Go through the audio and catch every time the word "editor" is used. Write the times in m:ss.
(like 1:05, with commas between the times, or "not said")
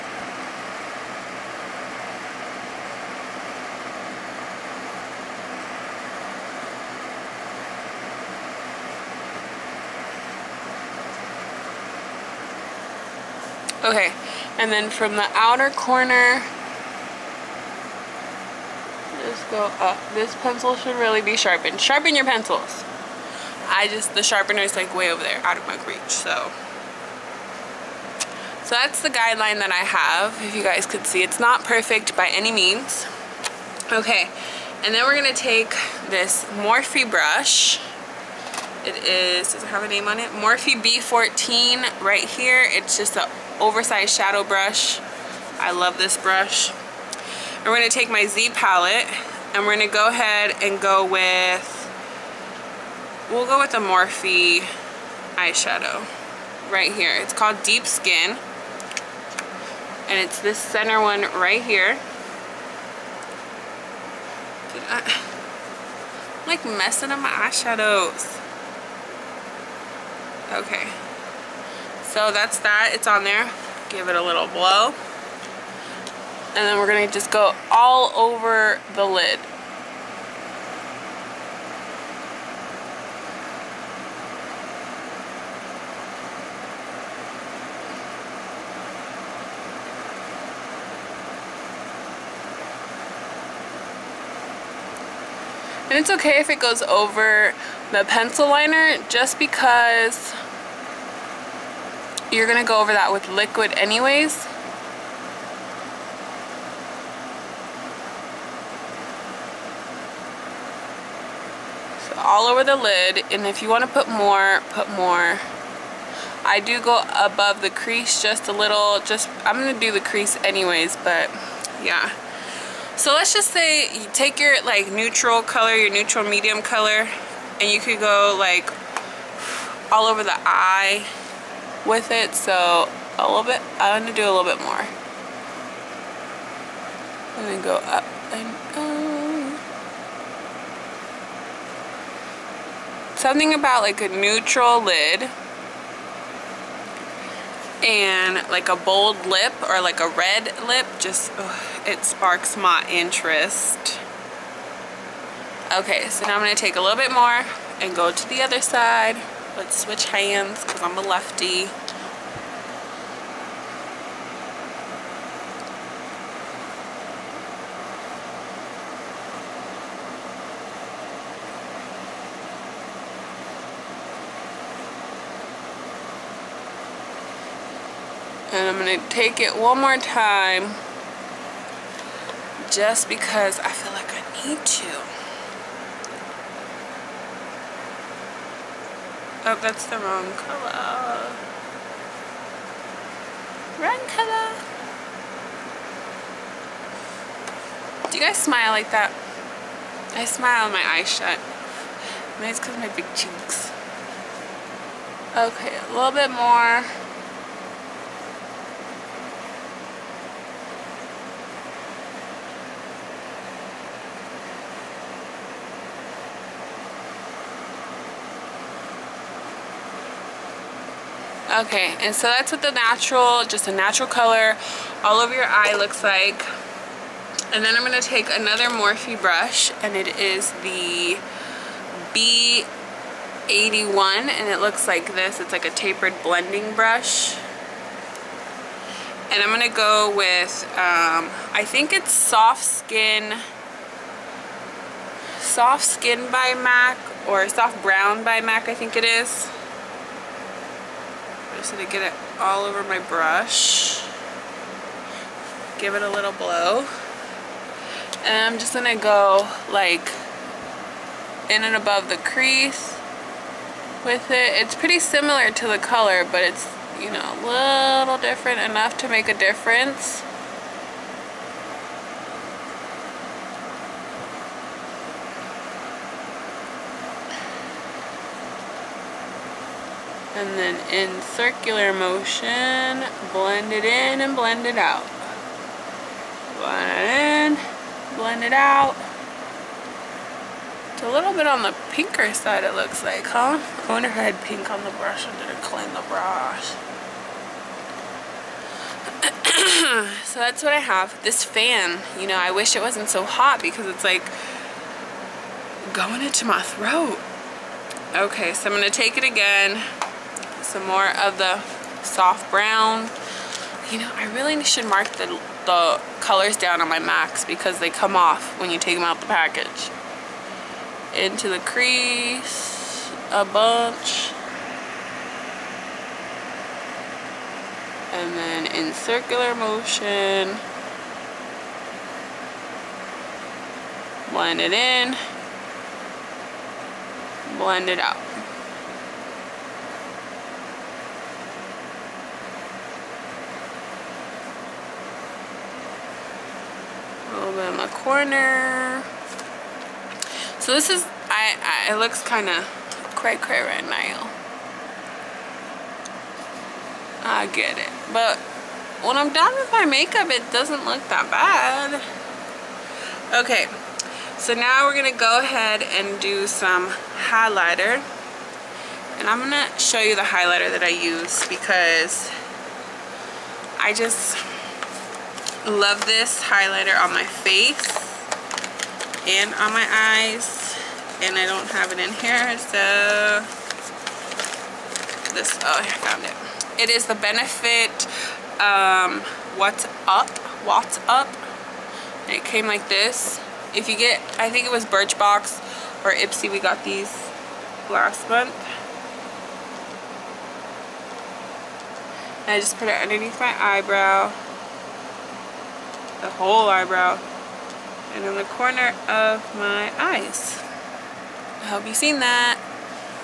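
not said.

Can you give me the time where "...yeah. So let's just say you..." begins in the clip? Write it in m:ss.
2:01.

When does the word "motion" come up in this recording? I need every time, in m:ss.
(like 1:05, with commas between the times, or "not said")
4:41, 5:29.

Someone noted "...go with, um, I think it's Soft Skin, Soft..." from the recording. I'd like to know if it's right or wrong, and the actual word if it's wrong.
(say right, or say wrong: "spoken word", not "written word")
right.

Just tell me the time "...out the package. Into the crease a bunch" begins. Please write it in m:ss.
5:19.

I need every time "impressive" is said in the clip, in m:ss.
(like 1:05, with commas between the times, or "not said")
not said.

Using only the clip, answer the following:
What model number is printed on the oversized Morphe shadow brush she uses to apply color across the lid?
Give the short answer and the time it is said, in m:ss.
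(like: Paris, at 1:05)
B14, at 0:40.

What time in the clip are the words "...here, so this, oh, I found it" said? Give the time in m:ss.
6:22.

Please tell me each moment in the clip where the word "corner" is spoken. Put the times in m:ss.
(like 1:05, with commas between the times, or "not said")
0:15, 5:47, 6:48.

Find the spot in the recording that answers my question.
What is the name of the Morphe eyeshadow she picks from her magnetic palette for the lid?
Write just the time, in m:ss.
0:57.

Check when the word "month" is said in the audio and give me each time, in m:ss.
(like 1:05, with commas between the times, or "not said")
6:38.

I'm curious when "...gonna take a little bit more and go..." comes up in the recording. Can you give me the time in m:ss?
2:36.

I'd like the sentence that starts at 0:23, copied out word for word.
I just, the sharpener is like way over there, out of my reach, so.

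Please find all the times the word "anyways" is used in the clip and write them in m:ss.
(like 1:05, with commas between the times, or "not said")
1:43, 2:00.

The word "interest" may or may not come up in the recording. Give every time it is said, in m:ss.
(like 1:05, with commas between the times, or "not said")
2:32.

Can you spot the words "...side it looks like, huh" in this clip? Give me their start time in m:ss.
4:52.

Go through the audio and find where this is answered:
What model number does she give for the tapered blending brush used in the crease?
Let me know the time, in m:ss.
3:52.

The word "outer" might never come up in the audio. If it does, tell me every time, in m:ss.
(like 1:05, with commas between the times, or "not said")
0:15.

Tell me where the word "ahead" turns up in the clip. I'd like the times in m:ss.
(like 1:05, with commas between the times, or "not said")
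0:50, 6:05.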